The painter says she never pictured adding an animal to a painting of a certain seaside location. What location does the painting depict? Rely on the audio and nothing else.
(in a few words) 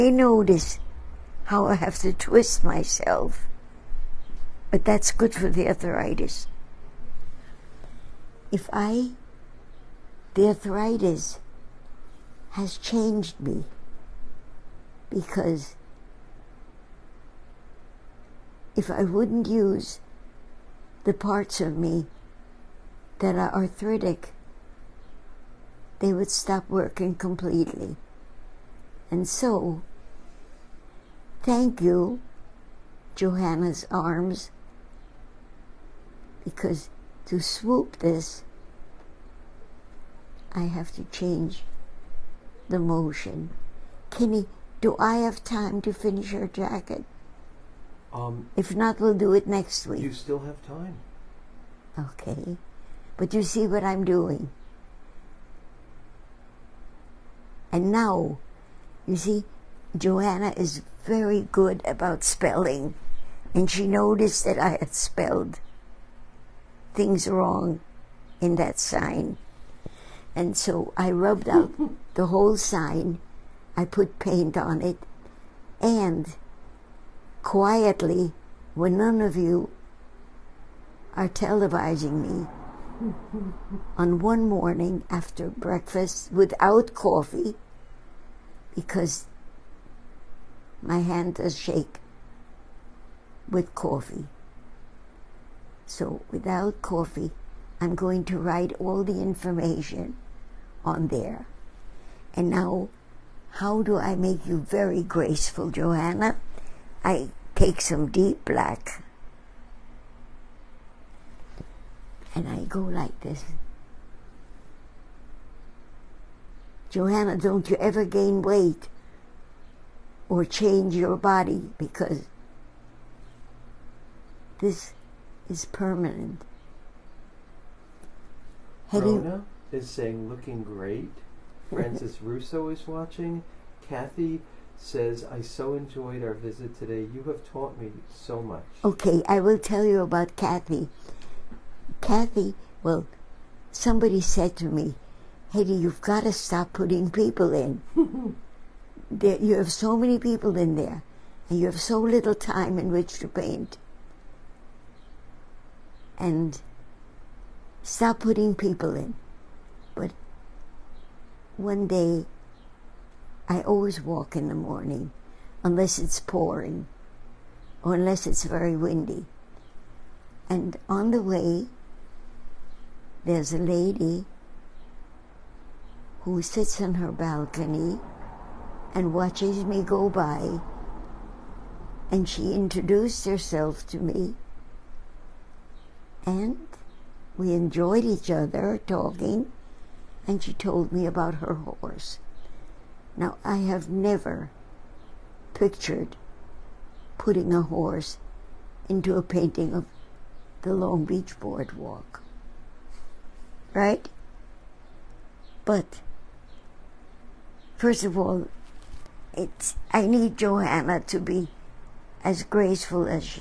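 Long Beach Boardwalk.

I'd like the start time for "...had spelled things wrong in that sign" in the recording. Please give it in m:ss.
1:04.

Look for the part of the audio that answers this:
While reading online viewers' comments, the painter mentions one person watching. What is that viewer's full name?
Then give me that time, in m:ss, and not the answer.
2:11.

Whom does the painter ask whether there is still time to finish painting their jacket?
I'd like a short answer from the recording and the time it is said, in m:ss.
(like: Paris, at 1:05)
Kenny, at 0:44.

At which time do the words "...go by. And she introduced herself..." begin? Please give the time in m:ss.
2:59.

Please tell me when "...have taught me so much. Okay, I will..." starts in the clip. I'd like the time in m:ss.
2:17.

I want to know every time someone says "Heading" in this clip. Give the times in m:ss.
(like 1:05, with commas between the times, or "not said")
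2:08.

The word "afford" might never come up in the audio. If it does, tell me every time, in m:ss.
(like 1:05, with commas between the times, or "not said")
not said.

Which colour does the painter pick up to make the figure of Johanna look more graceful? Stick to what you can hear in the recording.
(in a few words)
Deep black.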